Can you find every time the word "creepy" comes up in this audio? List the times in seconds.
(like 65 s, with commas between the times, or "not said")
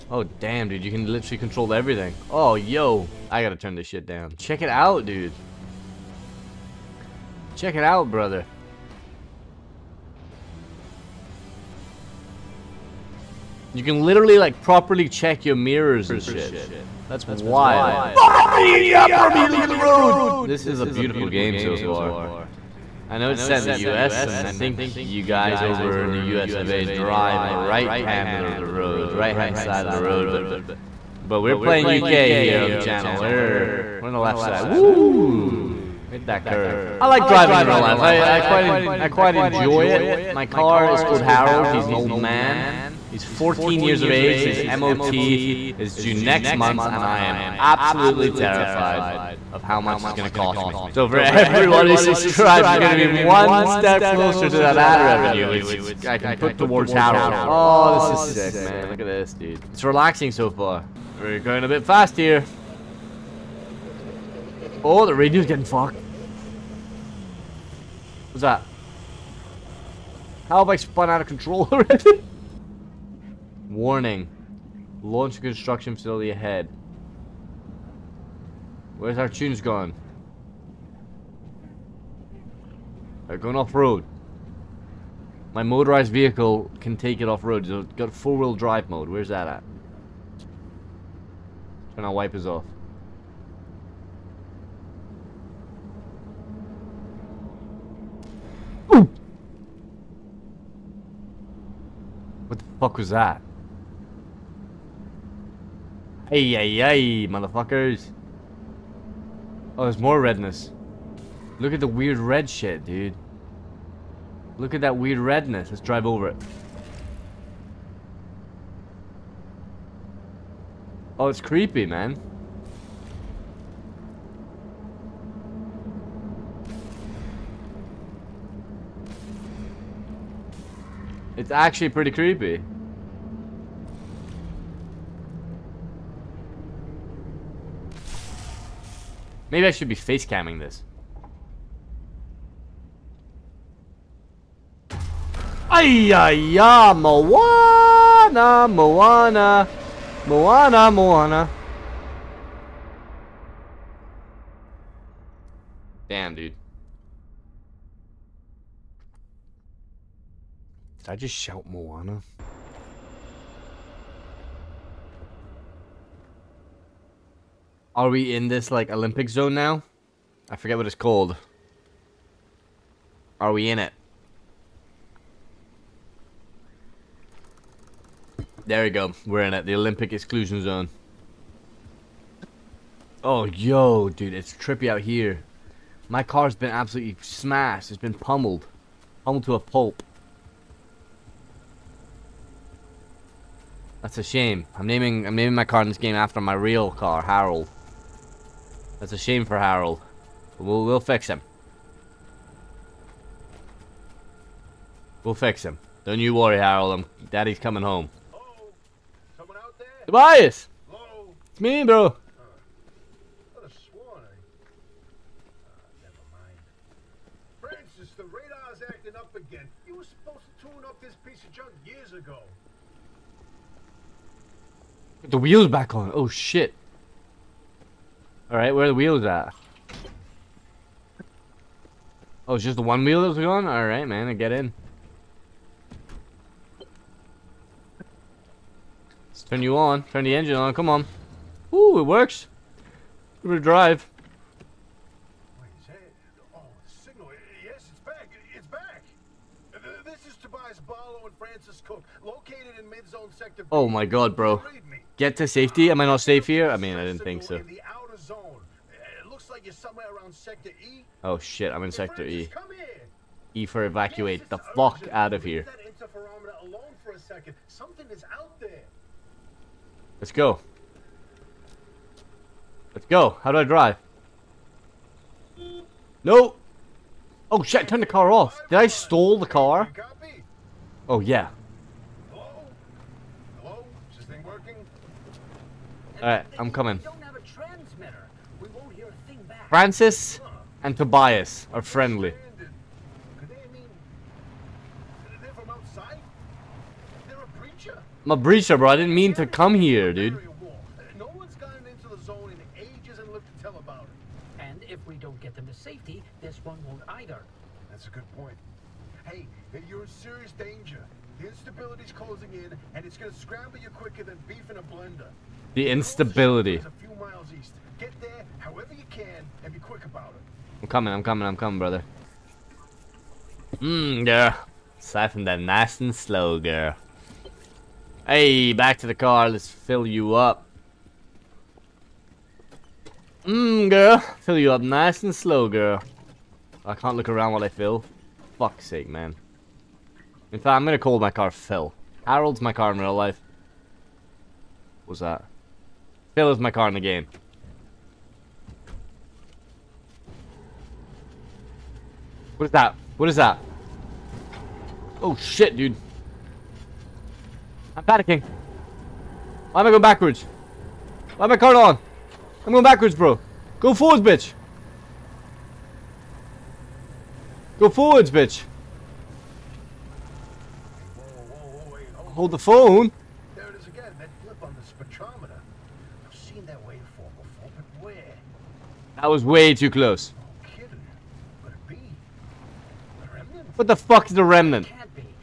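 121 s, 132 s.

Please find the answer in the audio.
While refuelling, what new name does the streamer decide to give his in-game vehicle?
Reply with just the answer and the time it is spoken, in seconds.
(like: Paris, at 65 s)
Phil, at 341 s.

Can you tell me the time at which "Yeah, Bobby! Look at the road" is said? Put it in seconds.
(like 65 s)
18 s.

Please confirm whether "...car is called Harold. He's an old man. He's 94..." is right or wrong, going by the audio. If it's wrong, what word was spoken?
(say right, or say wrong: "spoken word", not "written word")
wrong: "14", not "94".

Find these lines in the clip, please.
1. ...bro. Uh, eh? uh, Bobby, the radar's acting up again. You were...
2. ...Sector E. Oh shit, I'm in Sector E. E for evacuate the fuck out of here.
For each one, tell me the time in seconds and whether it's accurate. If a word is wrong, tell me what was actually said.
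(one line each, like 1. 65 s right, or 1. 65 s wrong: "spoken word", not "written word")
1. 211 s wrong: "Francis", not "Bobby"
2. 260 s right.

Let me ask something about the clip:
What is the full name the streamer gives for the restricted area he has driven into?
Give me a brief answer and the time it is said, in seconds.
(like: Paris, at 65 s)
Olympic exclusion zone, at 179 s.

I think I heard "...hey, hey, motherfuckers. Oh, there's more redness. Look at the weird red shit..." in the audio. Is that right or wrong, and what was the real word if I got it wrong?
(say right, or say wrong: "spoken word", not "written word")
right.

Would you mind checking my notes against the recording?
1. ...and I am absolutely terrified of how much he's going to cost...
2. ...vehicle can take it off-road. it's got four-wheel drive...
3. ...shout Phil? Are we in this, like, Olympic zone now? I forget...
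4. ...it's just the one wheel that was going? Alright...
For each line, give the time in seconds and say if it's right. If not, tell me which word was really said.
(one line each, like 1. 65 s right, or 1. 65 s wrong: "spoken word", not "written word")
1. 46 s right
2. 86 s right
3. 161 s wrong: "Moana", not "Phil"
4. 232 s right.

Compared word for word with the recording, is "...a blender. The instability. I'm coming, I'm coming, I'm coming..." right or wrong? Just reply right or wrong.
right.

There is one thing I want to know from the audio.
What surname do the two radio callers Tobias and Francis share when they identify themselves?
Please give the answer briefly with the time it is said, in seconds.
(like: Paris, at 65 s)
Cook, at 251 s.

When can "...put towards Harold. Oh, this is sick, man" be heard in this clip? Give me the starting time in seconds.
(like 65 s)
56 s.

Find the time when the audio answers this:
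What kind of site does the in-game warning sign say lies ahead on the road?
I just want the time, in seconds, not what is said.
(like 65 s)
75 s.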